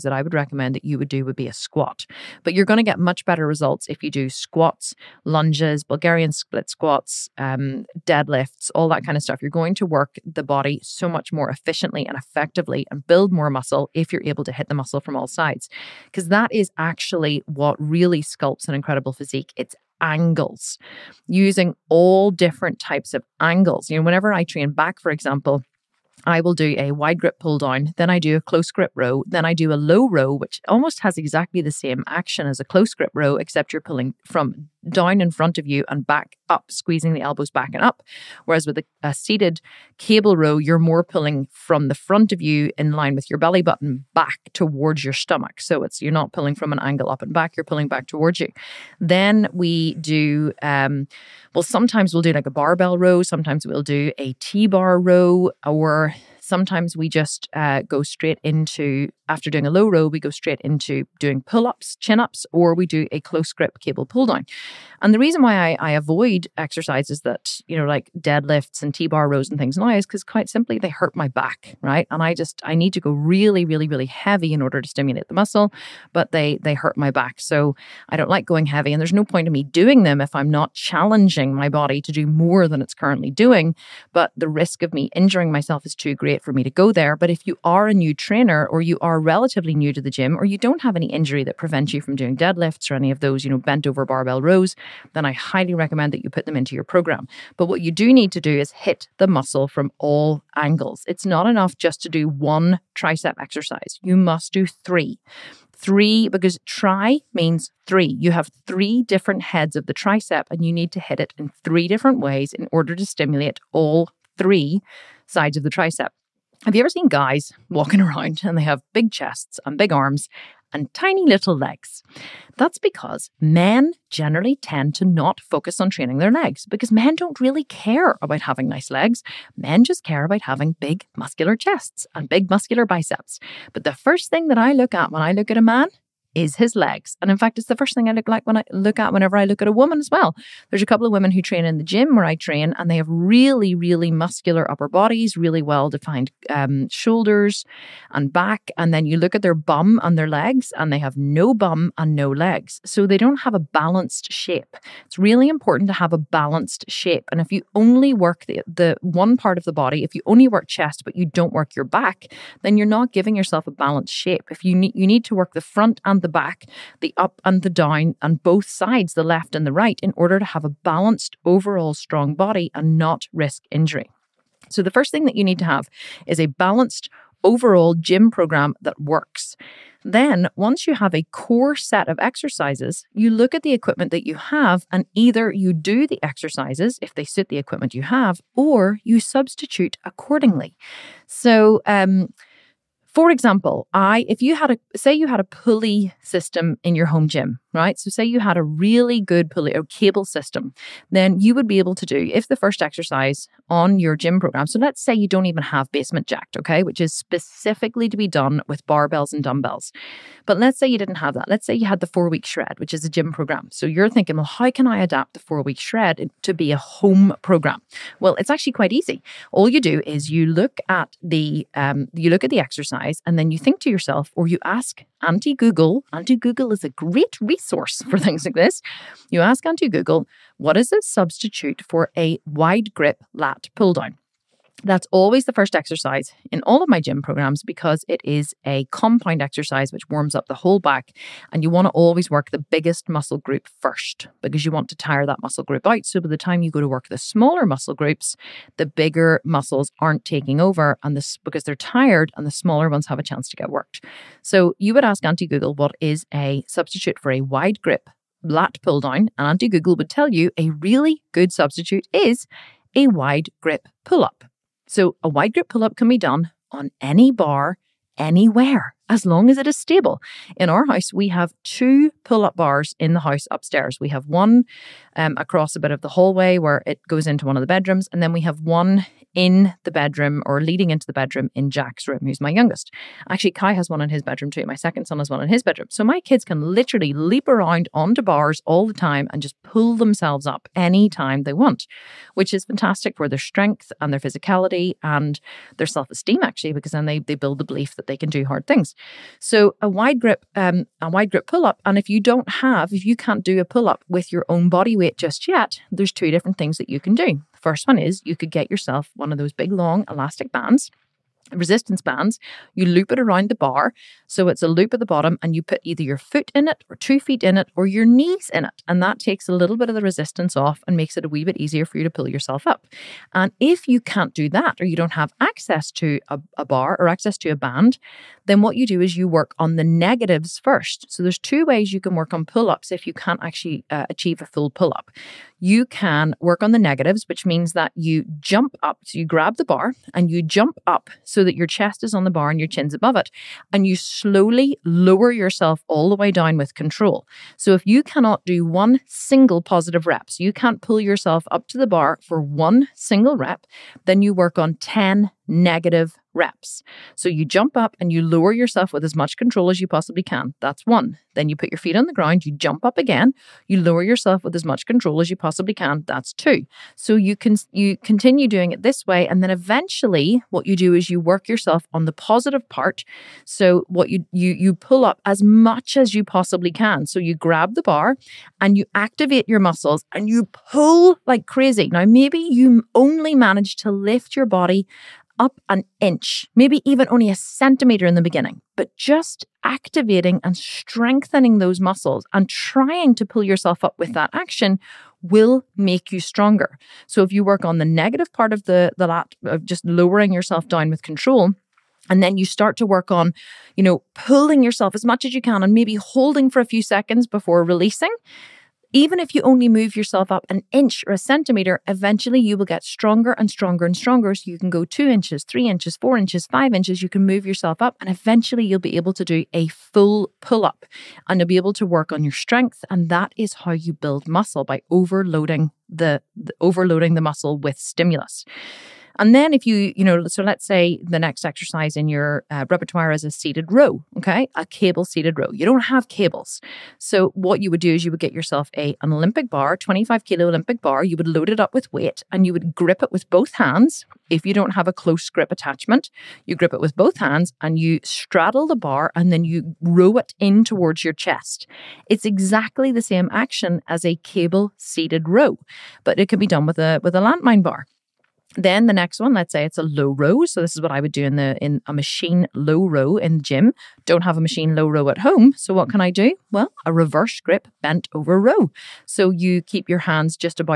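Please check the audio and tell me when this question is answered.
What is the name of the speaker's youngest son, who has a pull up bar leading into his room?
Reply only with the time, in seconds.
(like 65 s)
281 s.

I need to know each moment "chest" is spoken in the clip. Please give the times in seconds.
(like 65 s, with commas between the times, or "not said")
119 s, 131 s, 160 s, 341 s, 451 s.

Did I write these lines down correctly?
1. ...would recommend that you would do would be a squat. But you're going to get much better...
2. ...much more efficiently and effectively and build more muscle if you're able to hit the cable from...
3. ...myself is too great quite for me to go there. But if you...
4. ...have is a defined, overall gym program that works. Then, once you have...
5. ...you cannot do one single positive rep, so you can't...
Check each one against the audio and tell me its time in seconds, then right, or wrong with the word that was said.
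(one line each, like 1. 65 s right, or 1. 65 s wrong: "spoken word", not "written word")
1. 0 s right
2. 11 s wrong: "muscle", not "cable"
3. 85 s wrong: "appropriate", not "quite"
4. 175 s wrong: "balanced", not "defined"
5. 347 s right.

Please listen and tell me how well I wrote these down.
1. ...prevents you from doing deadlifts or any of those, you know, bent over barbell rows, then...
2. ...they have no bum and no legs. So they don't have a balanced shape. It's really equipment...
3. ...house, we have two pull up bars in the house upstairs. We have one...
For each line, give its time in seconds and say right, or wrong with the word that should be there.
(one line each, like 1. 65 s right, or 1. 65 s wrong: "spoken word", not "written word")
1. 91 s right
2. 150 s wrong: "important", not "equipment"
3. 270 s right.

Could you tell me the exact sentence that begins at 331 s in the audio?
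So there's two ways you can work on pull ups if you can't actually uh, achieve a full pull up.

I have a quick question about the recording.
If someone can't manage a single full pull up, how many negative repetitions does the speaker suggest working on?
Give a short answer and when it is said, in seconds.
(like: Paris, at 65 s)
10, at 354 s.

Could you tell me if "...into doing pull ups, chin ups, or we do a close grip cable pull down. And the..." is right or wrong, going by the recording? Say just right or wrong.
right.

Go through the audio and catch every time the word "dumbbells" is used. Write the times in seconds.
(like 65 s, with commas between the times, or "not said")
209 s.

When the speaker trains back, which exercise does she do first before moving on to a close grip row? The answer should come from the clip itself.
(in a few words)
Wide grip pull down.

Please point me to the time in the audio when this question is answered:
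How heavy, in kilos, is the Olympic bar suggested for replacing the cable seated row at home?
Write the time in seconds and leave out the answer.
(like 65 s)
439 s.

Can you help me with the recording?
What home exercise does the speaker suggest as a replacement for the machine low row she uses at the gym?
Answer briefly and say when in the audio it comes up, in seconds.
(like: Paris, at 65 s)
Reverse grip bent over row, at 466 s.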